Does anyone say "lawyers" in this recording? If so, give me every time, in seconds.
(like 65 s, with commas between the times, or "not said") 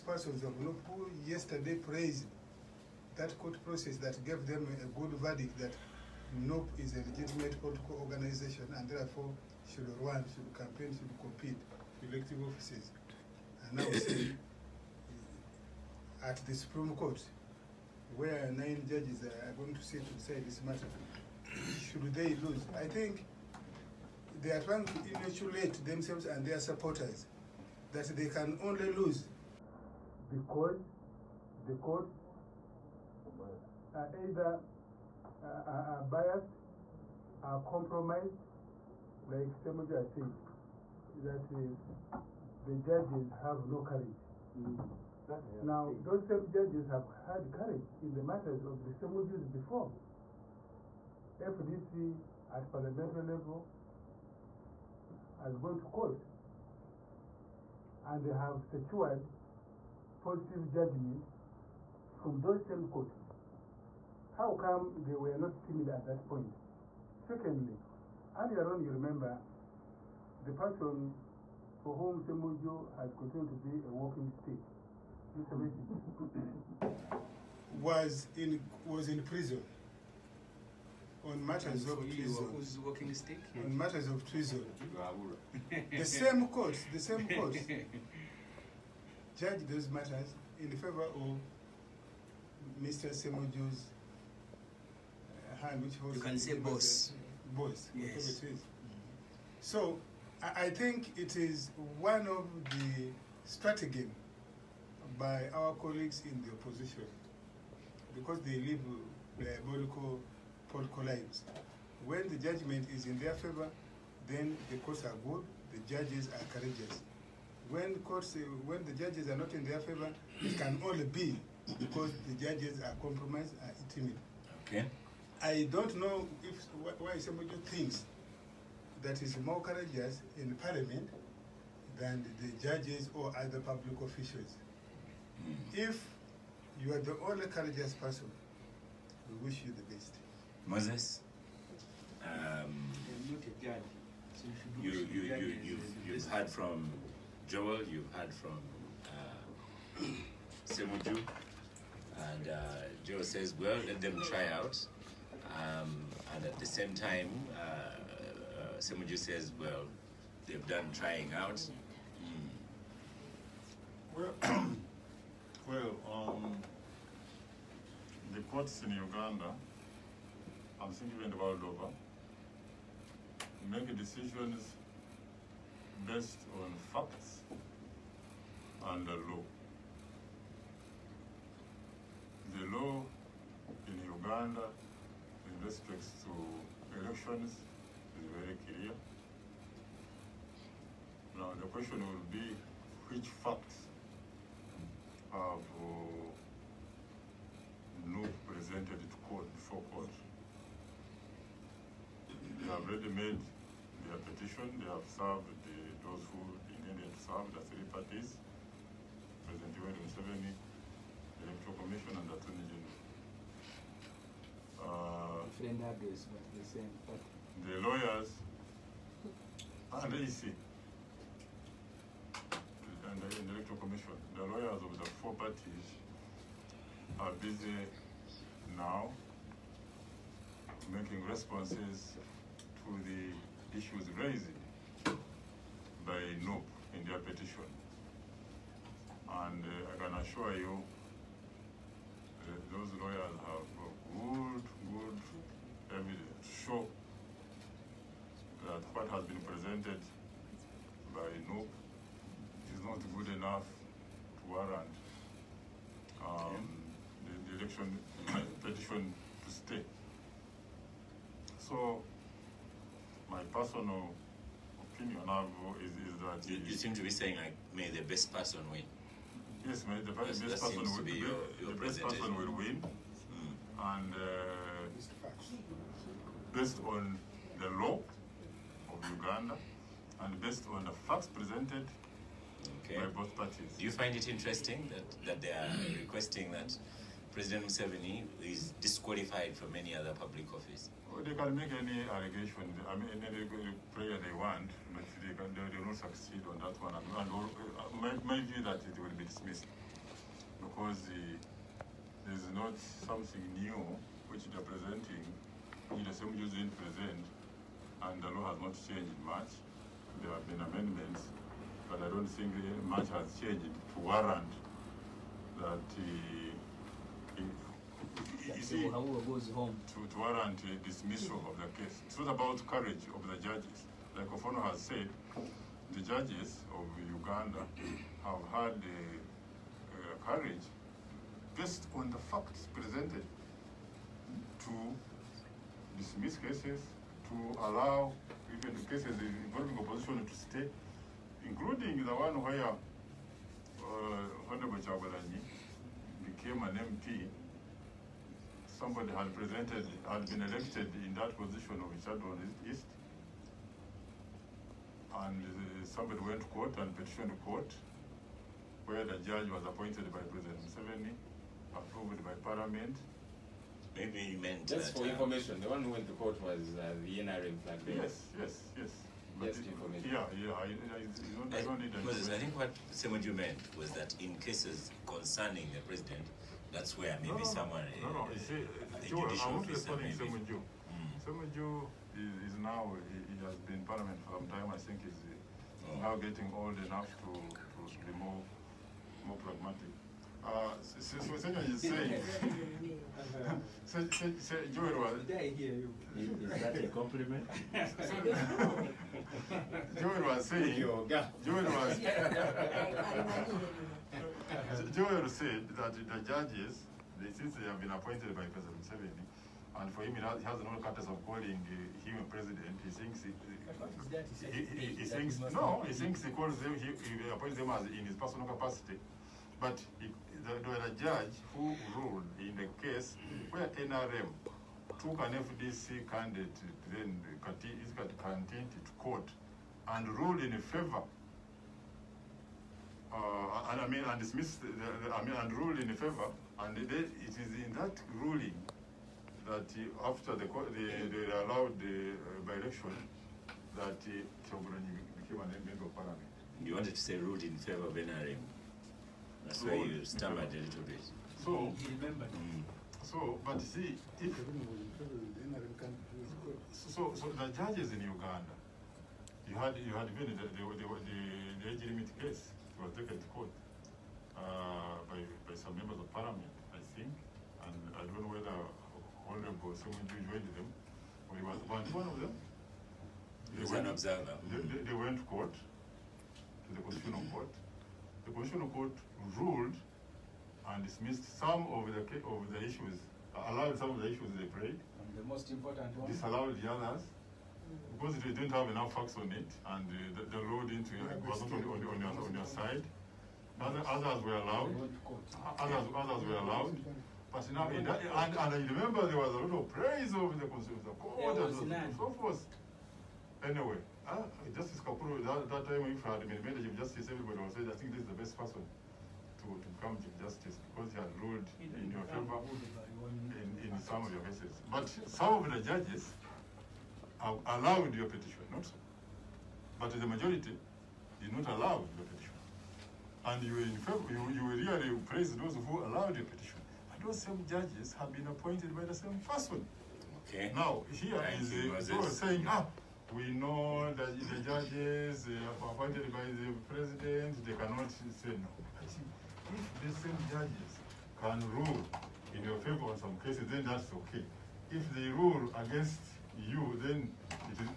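217 s, 224 s, 243 s.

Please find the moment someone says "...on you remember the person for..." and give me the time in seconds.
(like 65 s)
68 s.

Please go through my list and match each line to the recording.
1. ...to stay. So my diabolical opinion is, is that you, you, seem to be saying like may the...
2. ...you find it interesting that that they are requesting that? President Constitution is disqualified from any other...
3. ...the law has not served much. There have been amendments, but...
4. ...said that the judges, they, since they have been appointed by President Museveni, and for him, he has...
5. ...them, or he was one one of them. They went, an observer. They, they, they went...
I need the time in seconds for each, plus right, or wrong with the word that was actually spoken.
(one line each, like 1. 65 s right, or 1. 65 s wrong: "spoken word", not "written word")
1. 259 s wrong: "personal", not "diabolical"
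2. 283 s wrong: "Museveni", not "Constitution"
3. 308 s wrong: "changed", not "served"
4. 405 s right
5. 470 s right.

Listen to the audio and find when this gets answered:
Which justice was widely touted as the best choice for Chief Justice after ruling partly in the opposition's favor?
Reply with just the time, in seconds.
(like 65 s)
504 s.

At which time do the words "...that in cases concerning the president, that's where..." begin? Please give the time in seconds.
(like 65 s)
373 s.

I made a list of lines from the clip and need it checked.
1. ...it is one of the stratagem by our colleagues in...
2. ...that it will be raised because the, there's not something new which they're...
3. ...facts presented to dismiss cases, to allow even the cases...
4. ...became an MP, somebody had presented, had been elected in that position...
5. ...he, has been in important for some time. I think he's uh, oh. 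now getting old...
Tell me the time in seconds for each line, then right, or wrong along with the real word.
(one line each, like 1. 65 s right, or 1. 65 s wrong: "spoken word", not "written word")
1. 101 s right
2. 298 s wrong: "dismissed", not "raised"
3. 332 s right
4. 346 s right
5. 383 s wrong: "parliament", not "important".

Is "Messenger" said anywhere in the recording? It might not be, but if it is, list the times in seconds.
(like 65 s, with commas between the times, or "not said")
75 s.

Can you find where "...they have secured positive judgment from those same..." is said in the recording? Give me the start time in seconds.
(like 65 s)
58 s.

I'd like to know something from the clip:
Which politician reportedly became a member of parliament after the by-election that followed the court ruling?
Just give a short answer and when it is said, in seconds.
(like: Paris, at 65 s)
Choguranyi, at 444 s.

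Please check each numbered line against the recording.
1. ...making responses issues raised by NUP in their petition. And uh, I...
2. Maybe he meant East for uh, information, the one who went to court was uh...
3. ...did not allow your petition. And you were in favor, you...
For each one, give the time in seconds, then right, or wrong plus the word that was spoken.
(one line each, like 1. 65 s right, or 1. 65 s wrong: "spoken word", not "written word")
1. 230 s right
2. 363 s wrong: "Just", not "East"
3. 521 s right.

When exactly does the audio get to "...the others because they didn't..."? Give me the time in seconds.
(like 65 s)
486 s.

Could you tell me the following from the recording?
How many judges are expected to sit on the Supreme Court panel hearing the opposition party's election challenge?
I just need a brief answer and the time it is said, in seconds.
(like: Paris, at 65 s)
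9, at 18 s.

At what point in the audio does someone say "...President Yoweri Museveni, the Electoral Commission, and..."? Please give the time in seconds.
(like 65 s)
209 s.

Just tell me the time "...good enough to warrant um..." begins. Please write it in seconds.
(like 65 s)
253 s.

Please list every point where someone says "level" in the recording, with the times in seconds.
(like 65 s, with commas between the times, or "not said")
53 s.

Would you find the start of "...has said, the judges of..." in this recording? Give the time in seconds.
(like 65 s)
324 s.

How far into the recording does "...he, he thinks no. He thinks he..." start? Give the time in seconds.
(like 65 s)
414 s.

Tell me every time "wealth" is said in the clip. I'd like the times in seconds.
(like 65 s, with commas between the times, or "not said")
not said.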